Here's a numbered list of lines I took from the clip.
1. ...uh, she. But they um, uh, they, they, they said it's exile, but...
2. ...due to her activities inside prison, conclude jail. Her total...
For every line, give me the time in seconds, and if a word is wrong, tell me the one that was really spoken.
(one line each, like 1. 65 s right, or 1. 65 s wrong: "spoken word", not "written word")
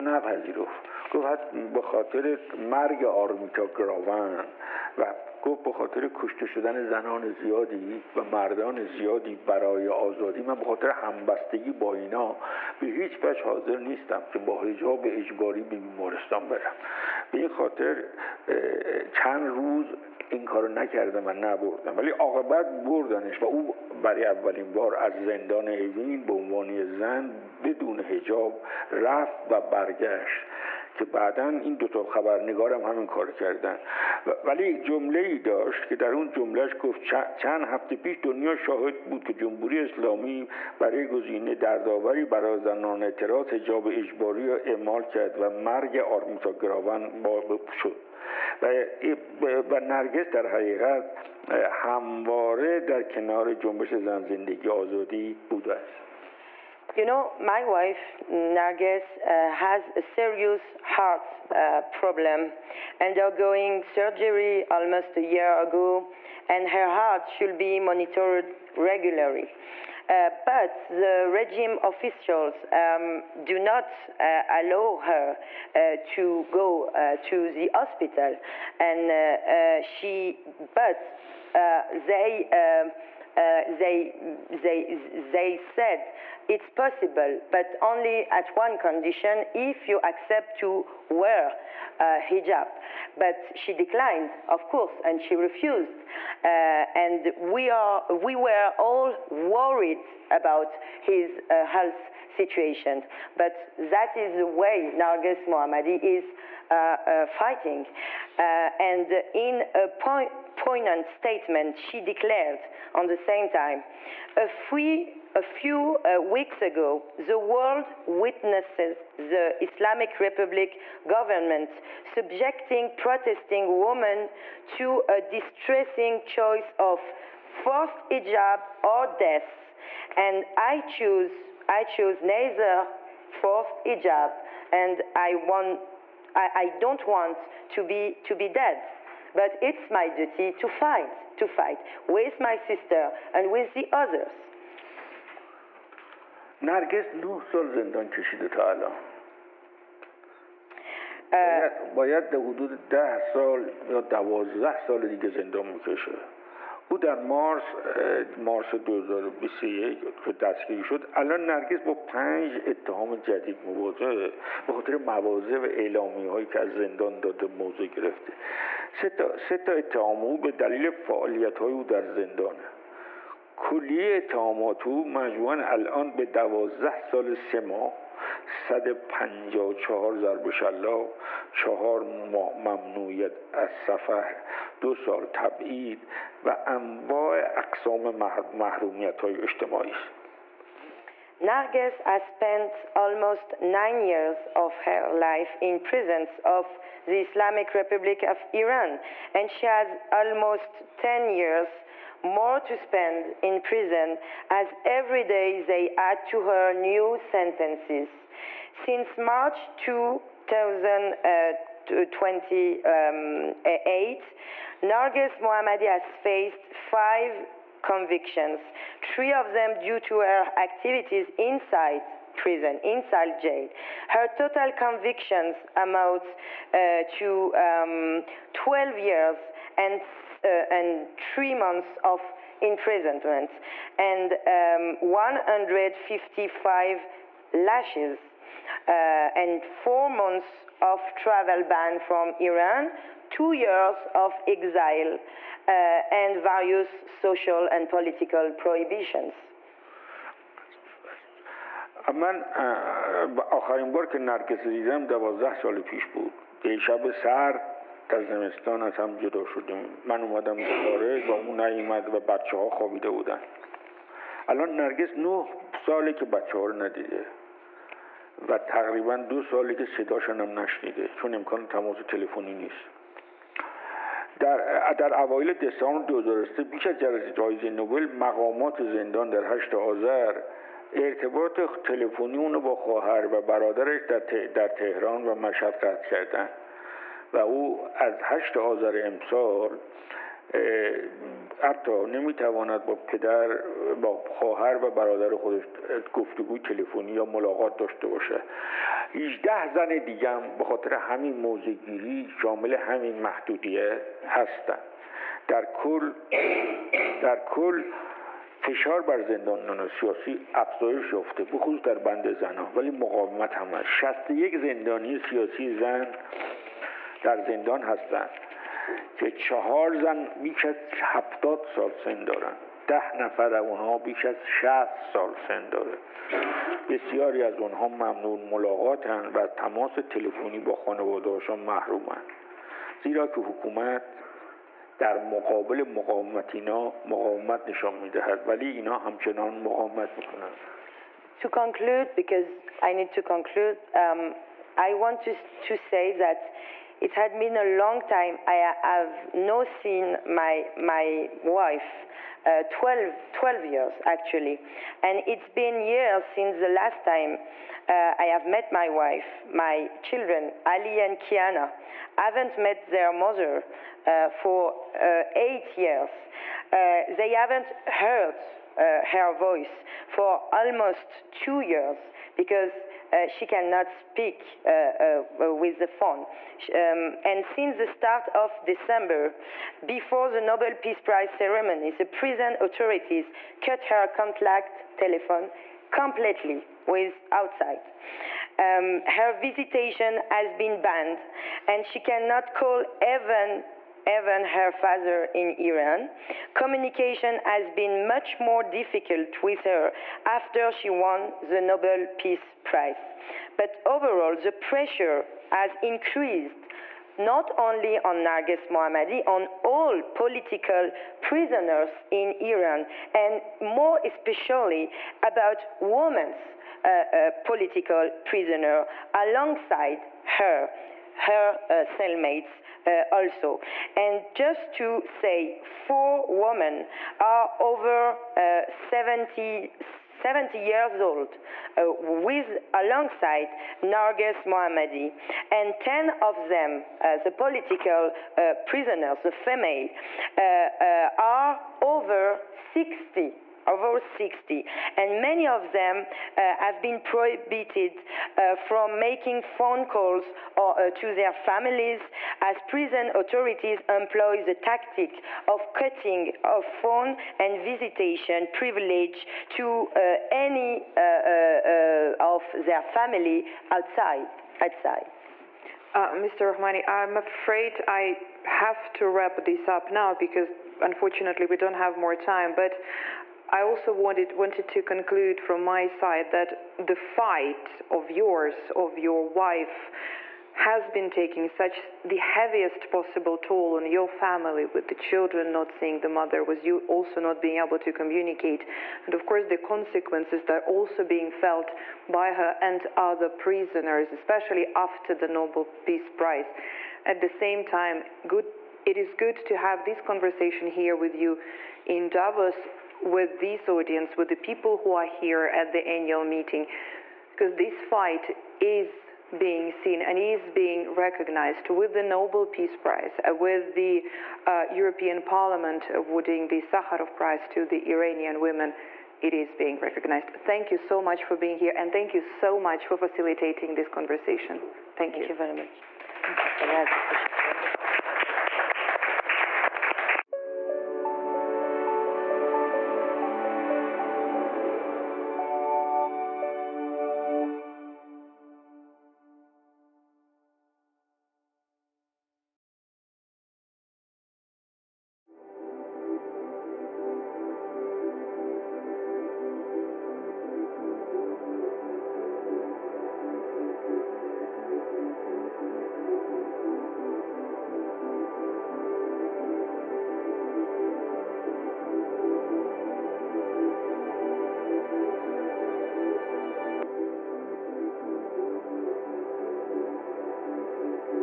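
1. 79 s wrong: "possible", not "exile"
2. 219 s wrong: "inside", not "conclude".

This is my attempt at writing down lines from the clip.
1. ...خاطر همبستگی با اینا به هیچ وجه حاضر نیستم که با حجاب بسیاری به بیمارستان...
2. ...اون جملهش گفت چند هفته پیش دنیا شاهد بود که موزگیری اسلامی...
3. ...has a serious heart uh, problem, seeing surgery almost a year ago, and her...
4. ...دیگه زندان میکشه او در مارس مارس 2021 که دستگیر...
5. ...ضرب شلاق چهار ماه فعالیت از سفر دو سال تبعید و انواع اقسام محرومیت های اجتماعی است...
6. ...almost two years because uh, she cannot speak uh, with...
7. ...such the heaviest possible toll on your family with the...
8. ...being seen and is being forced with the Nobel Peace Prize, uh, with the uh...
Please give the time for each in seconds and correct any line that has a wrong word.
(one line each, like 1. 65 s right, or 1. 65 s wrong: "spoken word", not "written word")
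1. 10 s wrong: "اجباری", not "بسیاری"
2. 36 s wrong: "جمهوری", not "موزگیری"
3. 59 s wrong: "undergoing", not "seeing"
4. 155 s right
5. 180 s wrong: "ممنوعیت", not "فعالیت"
6. 370 s right
7. 481 s right
8. 509 s wrong: "recognized", not "forced".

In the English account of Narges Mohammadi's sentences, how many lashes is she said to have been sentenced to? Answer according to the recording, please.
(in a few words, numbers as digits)
155.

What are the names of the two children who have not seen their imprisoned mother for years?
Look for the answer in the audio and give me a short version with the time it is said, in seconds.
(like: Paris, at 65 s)
Ali and Kiana, at 360 s.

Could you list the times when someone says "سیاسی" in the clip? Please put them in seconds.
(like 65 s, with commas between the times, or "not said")
309 s, 315 s.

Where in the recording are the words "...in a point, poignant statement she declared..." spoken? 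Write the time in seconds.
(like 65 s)
109 s.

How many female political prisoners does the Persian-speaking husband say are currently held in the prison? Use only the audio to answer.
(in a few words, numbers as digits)
61.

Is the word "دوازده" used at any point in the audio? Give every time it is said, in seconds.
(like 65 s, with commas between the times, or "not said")
154 s, 176 s, 255 s.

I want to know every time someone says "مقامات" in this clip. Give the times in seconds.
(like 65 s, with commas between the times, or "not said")
278 s.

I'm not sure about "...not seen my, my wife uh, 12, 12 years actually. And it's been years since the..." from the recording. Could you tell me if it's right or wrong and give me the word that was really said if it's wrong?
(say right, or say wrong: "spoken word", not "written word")
right.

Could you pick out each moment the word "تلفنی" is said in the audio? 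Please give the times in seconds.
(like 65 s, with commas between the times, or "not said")
272 s, 281 s, 296 s, 330 s.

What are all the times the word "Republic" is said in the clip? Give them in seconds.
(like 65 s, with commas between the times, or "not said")
120 s, 197 s.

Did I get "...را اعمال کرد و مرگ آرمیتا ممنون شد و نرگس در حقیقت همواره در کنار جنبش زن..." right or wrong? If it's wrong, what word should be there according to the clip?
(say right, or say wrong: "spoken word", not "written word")
wrong: "گراون", not "ممنون".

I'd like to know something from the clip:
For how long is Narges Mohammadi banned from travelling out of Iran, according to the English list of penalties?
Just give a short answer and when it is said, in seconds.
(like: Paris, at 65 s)
4 months, at 239 s.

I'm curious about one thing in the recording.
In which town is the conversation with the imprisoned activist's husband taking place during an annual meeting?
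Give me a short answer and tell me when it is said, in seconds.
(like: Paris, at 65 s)
Davos, at 502 s.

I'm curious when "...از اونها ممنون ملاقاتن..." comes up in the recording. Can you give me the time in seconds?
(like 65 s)
327 s.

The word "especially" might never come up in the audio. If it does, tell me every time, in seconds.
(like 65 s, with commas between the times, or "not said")
414 s, 494 s.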